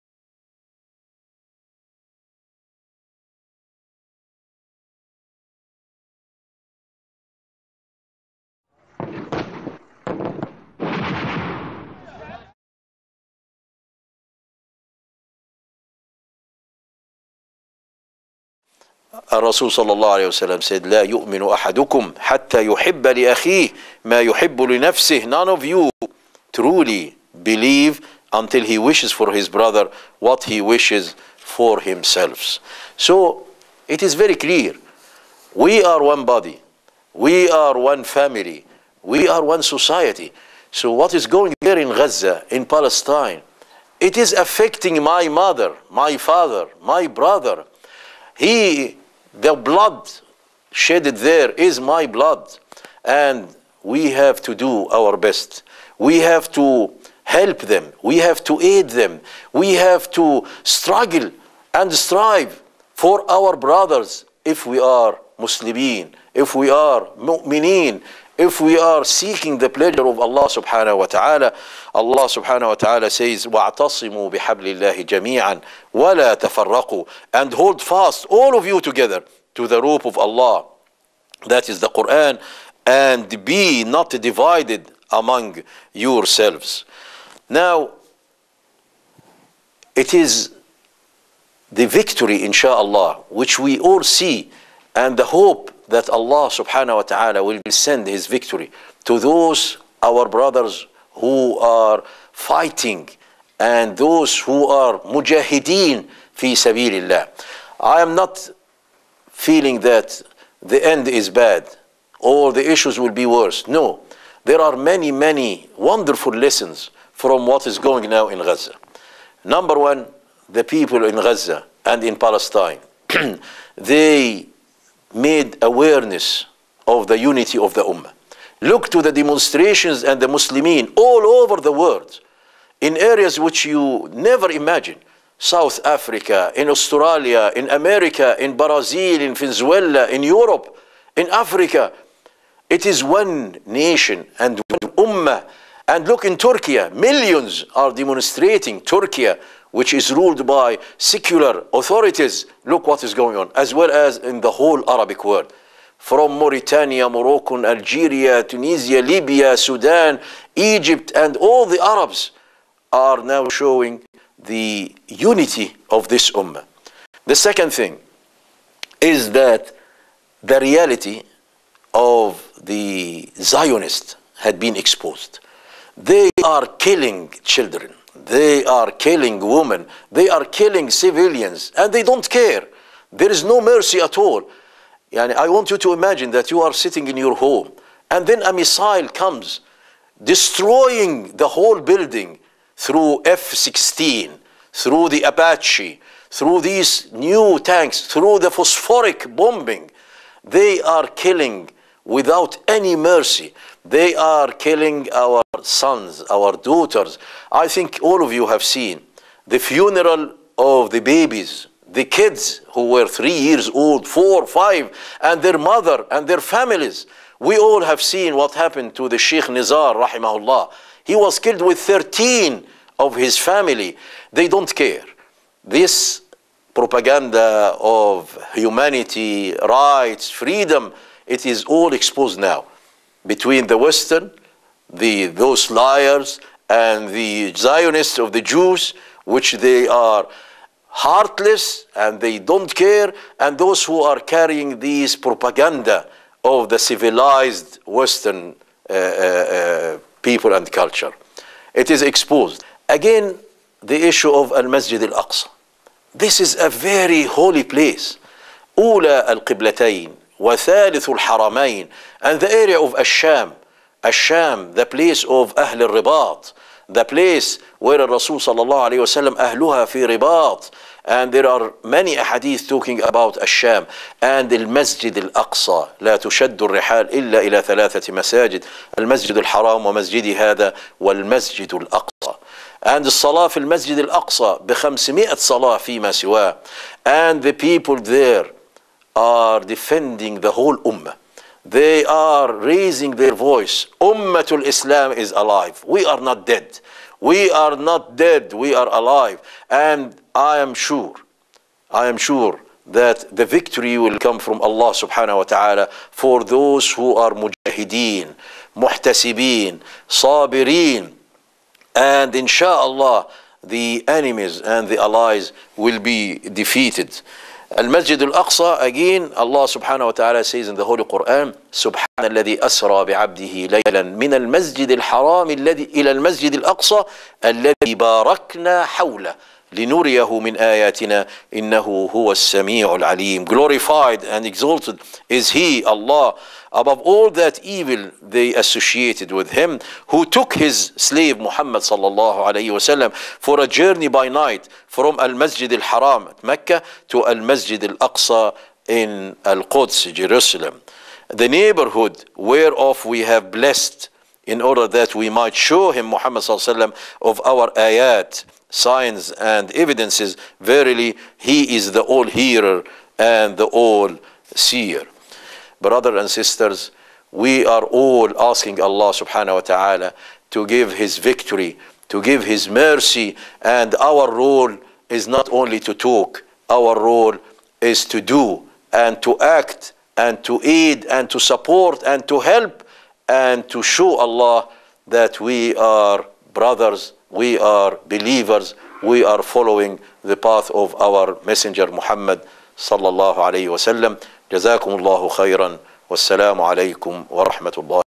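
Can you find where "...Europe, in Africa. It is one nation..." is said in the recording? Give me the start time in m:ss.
2:20.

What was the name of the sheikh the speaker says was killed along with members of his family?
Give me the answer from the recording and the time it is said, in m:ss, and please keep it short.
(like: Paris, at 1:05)
Sheikh Nizar, at 3:39.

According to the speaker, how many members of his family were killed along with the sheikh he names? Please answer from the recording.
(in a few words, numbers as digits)
13.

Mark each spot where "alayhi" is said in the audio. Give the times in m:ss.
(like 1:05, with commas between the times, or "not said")
5:42, 5:56, 6:33.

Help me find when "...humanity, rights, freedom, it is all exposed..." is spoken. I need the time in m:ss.
3:48.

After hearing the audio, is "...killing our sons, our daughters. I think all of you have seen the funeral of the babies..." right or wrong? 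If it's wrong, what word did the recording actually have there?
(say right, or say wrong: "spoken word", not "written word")
right.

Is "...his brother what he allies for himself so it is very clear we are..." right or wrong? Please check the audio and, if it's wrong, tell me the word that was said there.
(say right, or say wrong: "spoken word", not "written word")
wrong: "wishes", not "allies".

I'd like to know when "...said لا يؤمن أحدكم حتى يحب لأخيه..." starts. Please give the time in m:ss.
0:20.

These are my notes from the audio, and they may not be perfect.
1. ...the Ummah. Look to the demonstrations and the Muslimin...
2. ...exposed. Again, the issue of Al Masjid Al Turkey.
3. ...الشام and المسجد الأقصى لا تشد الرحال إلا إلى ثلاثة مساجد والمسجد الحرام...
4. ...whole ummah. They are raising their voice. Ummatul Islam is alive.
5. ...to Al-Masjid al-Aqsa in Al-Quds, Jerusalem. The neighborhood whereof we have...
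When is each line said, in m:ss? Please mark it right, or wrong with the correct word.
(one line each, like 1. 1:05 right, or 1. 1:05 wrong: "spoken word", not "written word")
1. 2:07 right
2. 4:12 wrong: "Aqsa", not "Turkey"
3. 4:33 wrong: "المسجد", not "والمسجد"
4. 4:50 right
5. 5:47 right.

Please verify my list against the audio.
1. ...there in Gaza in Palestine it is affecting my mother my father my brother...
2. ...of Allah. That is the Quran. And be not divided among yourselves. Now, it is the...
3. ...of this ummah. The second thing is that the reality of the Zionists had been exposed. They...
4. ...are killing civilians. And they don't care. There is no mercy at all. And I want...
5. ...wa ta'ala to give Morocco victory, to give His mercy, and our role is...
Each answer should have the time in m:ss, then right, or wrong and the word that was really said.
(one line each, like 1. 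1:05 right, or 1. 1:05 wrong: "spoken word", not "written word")
1. 0:41 right
2. 1:20 right
3. 2:45 right
4. 3:00 right
5. 6:09 wrong: "His", not "Morocco".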